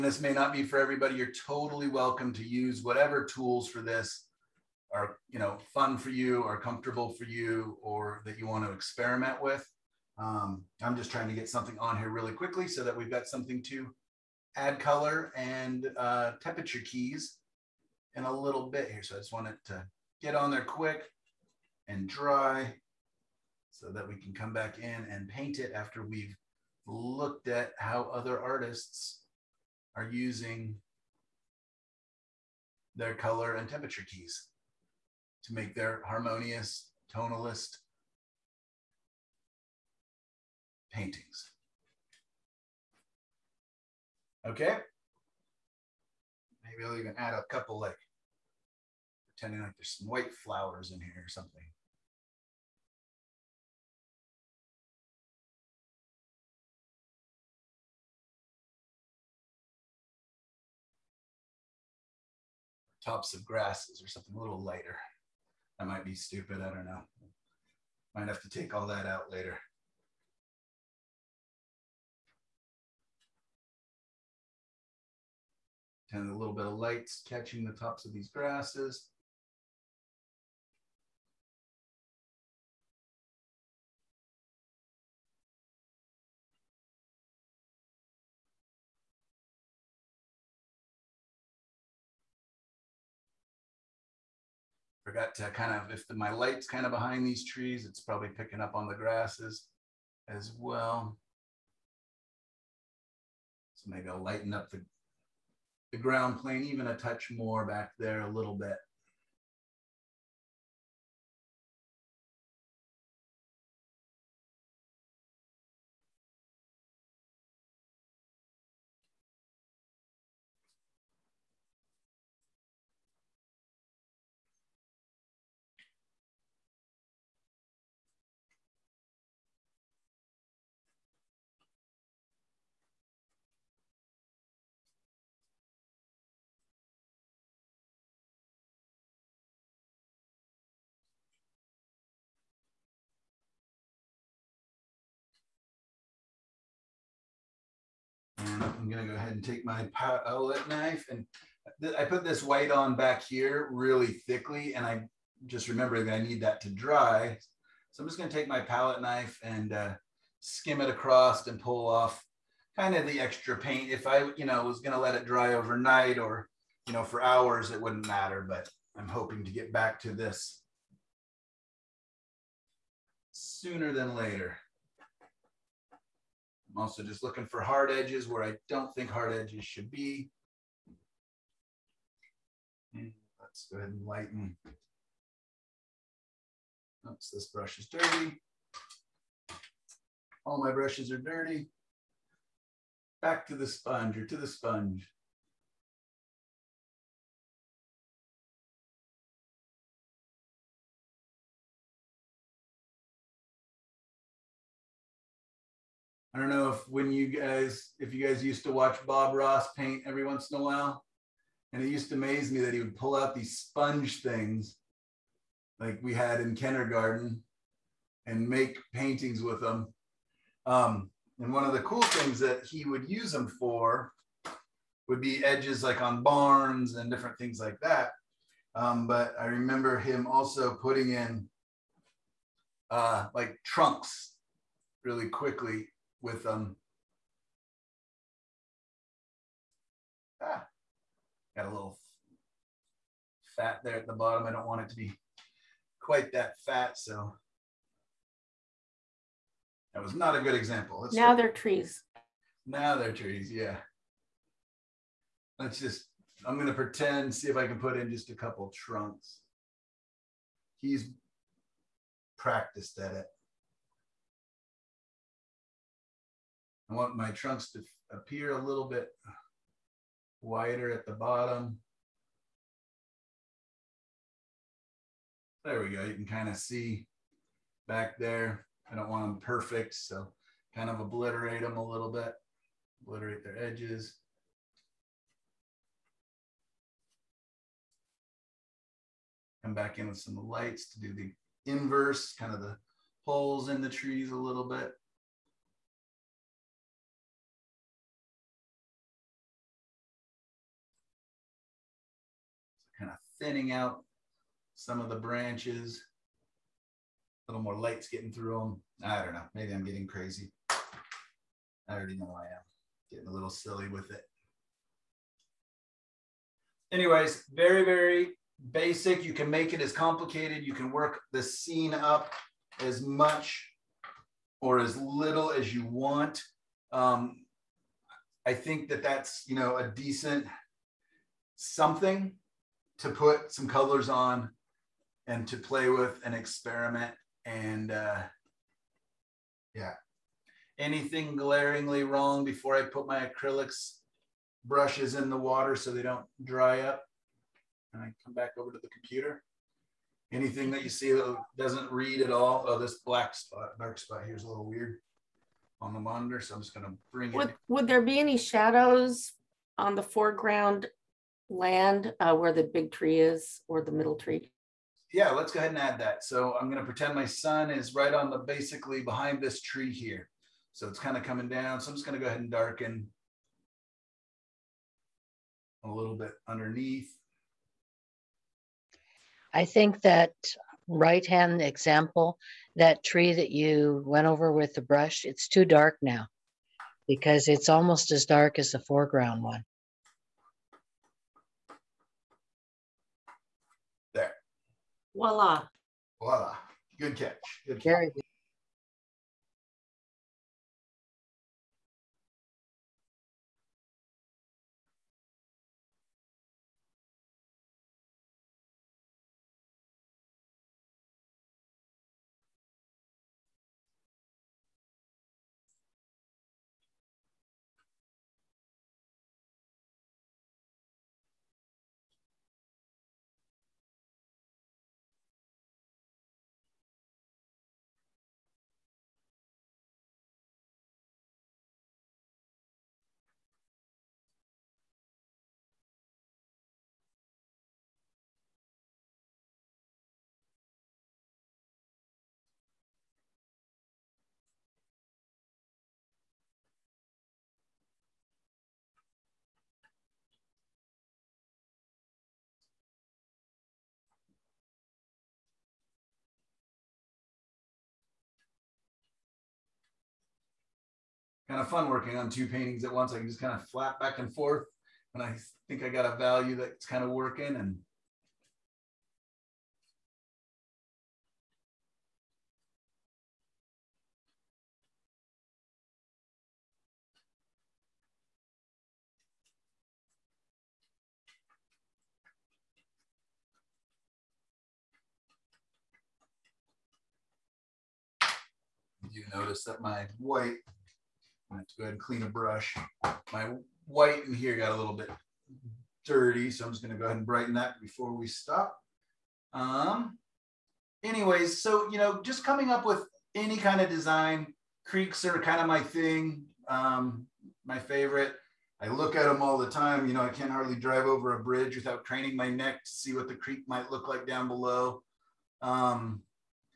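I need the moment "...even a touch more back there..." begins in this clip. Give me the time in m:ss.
1:46.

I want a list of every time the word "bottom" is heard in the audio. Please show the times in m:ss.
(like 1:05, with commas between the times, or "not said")
4:04, 4:31.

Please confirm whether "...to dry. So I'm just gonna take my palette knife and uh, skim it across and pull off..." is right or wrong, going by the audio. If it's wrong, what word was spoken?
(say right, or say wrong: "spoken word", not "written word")
right.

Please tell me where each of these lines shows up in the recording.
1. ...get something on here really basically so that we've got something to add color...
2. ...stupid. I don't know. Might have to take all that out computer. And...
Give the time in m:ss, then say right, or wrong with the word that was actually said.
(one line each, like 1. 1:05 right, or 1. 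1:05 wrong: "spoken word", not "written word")
1. 0:11 wrong: "quickly", not "basically"
2. 1:06 wrong: "later", not "computer".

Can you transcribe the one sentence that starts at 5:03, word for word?
thinning out some of the branches.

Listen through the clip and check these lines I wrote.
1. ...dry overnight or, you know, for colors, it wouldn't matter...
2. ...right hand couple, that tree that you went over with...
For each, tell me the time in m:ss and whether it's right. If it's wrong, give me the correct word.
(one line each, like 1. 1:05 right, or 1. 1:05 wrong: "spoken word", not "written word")
1. 2:45 wrong: "hours", not "colors"
2. 6:20 wrong: "example", not "couple".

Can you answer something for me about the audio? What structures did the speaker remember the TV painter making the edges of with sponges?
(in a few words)
barns.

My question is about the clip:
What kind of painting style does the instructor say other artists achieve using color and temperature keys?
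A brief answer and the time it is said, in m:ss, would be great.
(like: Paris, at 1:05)
harmonious, tonalist paintings, at 0:36.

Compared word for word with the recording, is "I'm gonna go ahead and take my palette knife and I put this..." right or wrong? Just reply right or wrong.
right.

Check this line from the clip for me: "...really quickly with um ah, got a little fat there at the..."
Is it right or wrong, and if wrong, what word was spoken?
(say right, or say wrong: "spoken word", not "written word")
right.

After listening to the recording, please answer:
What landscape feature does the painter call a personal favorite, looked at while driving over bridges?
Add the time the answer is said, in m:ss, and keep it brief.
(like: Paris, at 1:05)
creeks, at 8:24.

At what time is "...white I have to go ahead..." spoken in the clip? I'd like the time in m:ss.
8:10.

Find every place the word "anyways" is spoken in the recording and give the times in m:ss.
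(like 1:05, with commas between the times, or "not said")
5:16, 8:21.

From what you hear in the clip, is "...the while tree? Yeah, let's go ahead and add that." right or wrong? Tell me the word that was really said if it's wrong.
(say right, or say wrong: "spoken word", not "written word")
wrong: "middle", not "while".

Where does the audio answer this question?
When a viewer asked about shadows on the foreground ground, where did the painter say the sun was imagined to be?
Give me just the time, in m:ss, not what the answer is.
6:09.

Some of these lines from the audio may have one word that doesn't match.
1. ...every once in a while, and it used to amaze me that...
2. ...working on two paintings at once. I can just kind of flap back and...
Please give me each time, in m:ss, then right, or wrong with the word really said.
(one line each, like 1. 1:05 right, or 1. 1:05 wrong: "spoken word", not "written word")
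1. 3:30 right
2. 7:41 right.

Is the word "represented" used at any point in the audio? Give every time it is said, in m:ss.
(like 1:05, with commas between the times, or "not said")
not said.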